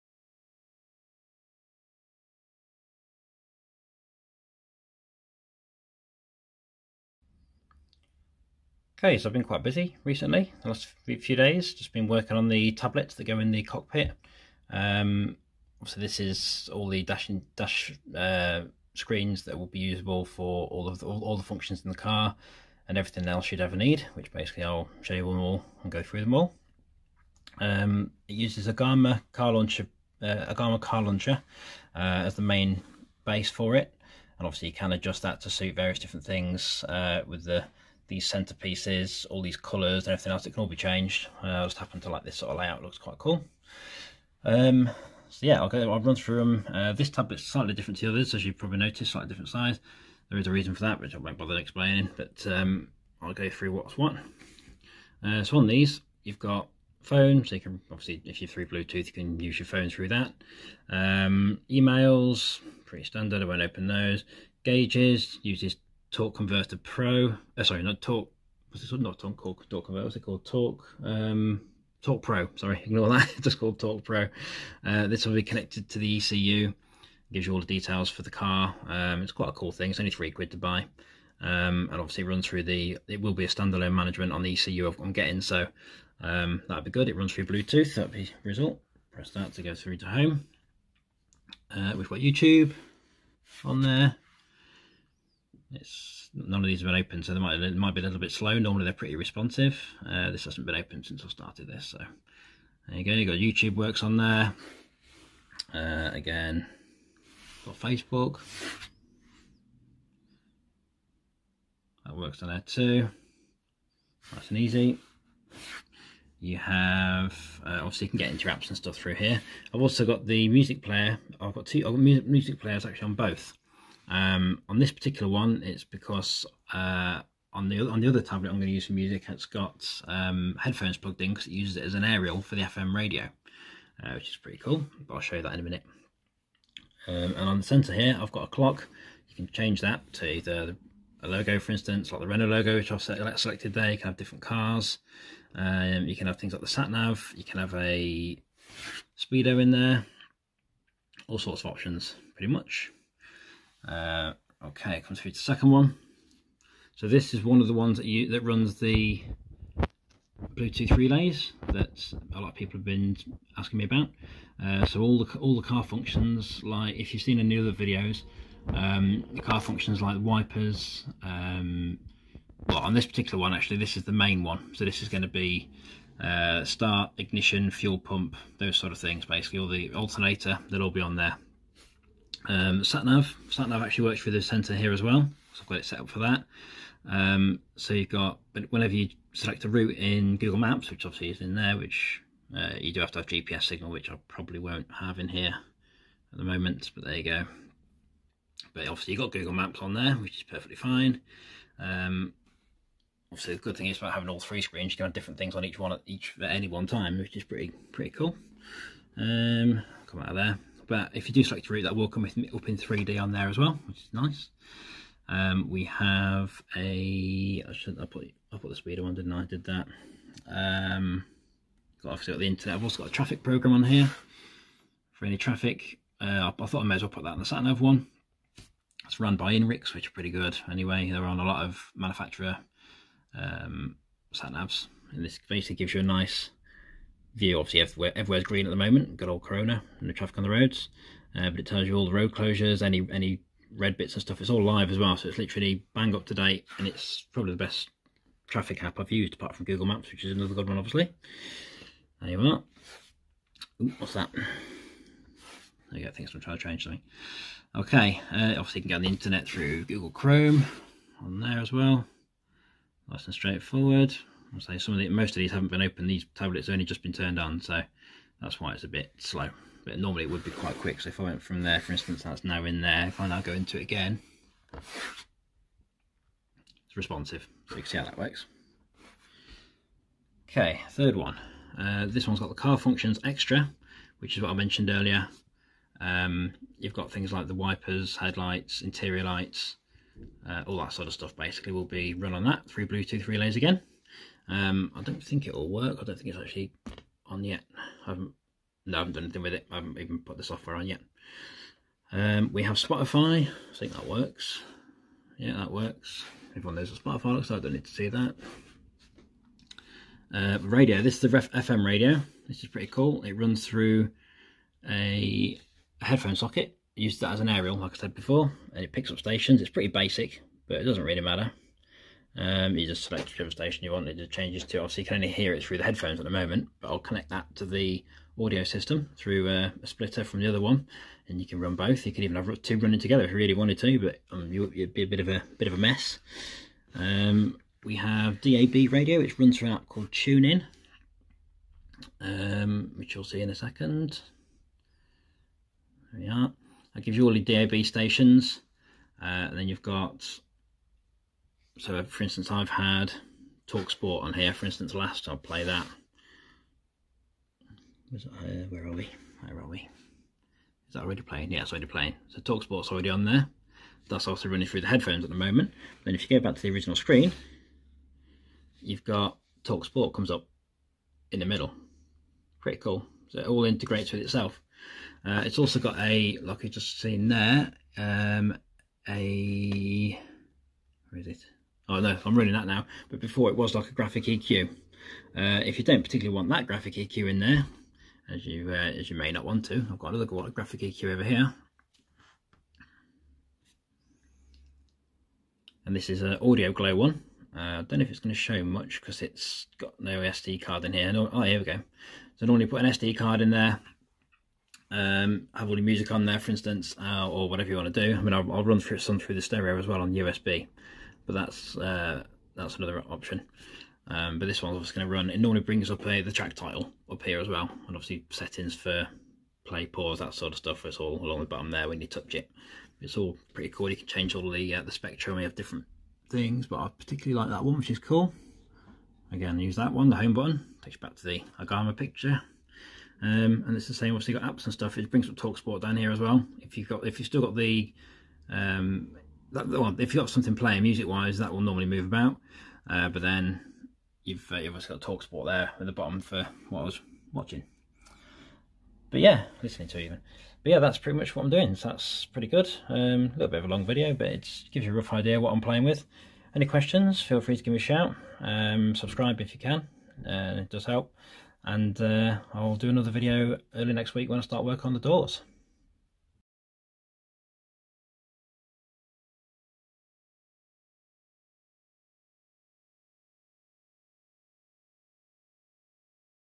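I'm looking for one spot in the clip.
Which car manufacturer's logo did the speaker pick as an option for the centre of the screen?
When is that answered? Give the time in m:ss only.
2:22.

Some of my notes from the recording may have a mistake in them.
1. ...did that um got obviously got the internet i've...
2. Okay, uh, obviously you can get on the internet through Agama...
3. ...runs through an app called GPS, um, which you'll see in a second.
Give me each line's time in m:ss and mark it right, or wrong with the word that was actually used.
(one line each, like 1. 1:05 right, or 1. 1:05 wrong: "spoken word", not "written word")
1. 3:39 right
2. 4:17 wrong: "Google", not "Agama"
3. 5:39 wrong: "TuneIn", not "GPS".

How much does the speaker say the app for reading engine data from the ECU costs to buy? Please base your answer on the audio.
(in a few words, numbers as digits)
3 quid.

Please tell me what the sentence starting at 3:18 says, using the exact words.
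But obviously you've got Google Maps on there, which is perfectly fine.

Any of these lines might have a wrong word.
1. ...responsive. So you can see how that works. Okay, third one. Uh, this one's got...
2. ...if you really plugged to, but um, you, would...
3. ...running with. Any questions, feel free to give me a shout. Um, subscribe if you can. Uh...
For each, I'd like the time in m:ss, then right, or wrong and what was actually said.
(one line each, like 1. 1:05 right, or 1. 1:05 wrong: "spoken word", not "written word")
1. 4:36 right
2. 5:33 wrong: "wanted", not "plugged"
3. 7:35 wrong: "playing", not "running".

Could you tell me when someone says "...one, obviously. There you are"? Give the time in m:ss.
4:10.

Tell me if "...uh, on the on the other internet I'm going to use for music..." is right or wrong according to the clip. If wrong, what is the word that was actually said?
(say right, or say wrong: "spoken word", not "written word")
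wrong: "tablet", not "internet".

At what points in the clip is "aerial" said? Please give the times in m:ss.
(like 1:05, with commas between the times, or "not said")
2:12, 5:17.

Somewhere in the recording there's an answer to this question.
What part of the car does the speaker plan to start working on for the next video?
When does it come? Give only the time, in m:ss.
7:44.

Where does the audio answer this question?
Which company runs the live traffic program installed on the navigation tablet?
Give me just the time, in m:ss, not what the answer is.
3:49.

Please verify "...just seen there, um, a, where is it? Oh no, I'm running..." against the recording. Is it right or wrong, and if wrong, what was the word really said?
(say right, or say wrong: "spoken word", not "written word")
right.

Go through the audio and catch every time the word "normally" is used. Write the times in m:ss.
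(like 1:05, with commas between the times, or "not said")
1:38, 4:29, 6:42, 6:55, 7:21.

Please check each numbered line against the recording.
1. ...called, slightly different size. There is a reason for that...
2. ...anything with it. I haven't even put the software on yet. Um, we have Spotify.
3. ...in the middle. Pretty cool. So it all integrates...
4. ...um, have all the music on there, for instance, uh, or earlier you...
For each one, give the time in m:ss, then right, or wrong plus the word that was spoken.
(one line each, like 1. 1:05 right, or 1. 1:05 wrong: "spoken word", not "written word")
1. 0:48 wrong: "noticed", not "called"
2. 4:59 right
3. 6:11 right
4. 6:44 wrong: "whatever", not "earlier".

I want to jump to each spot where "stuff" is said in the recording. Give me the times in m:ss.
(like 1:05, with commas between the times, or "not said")
1:58, 4:04, 4:51, 7:00, 7:14.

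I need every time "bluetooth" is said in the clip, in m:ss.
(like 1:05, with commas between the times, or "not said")
0:58, 1:27, 2:40, 4:52.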